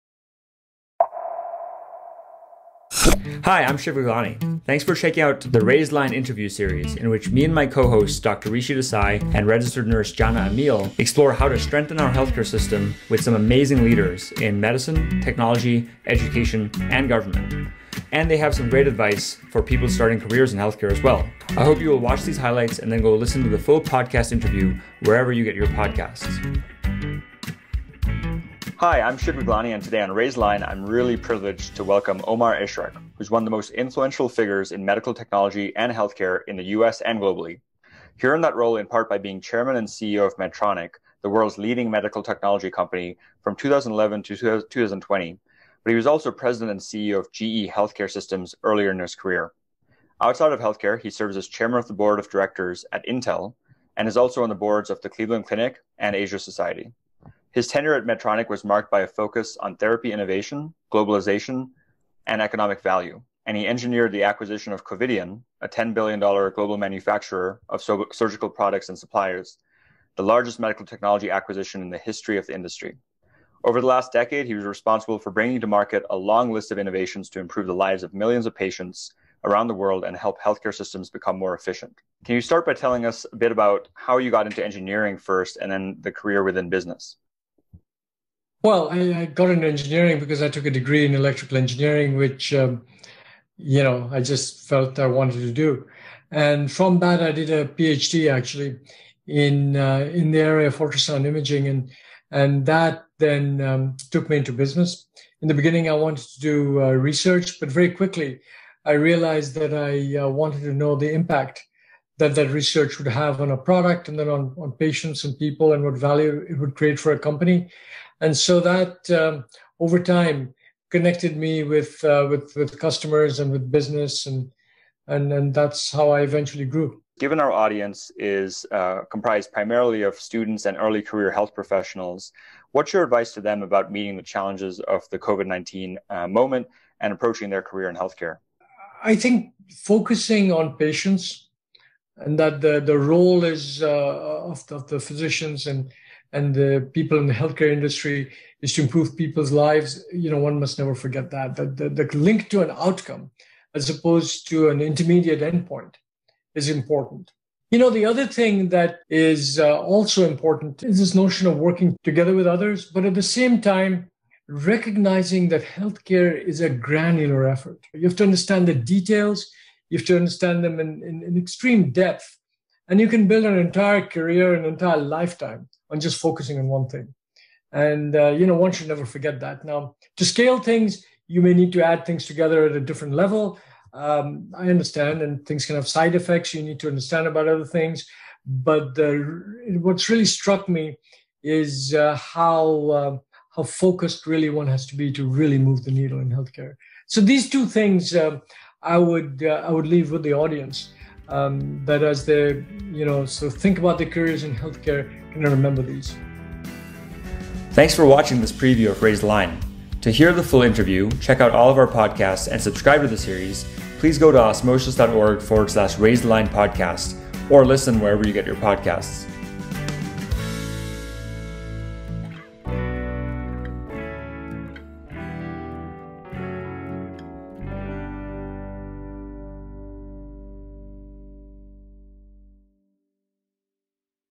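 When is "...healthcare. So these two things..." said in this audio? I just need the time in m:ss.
3:16.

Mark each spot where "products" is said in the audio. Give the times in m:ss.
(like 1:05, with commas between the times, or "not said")
1:08, 1:53.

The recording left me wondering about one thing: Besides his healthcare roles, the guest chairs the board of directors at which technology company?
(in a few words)
Intel.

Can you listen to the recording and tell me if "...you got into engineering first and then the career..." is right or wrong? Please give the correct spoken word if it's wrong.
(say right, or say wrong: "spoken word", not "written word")
right.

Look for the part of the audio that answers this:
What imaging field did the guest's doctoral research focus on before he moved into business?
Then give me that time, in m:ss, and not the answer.
1:40.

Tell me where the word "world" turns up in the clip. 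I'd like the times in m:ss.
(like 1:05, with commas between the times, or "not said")
0:41, 1:19.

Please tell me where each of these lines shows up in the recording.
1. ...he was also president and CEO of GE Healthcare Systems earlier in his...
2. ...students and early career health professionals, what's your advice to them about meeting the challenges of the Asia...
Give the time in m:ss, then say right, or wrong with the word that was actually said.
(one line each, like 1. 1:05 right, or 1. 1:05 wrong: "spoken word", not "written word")
1. 0:45 right
2. 2:10 wrong: "COVID", not "Asia".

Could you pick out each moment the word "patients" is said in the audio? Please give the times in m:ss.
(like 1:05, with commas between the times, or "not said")
1:18, 1:54, 2:20.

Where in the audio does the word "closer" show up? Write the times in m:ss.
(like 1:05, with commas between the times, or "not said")
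not said.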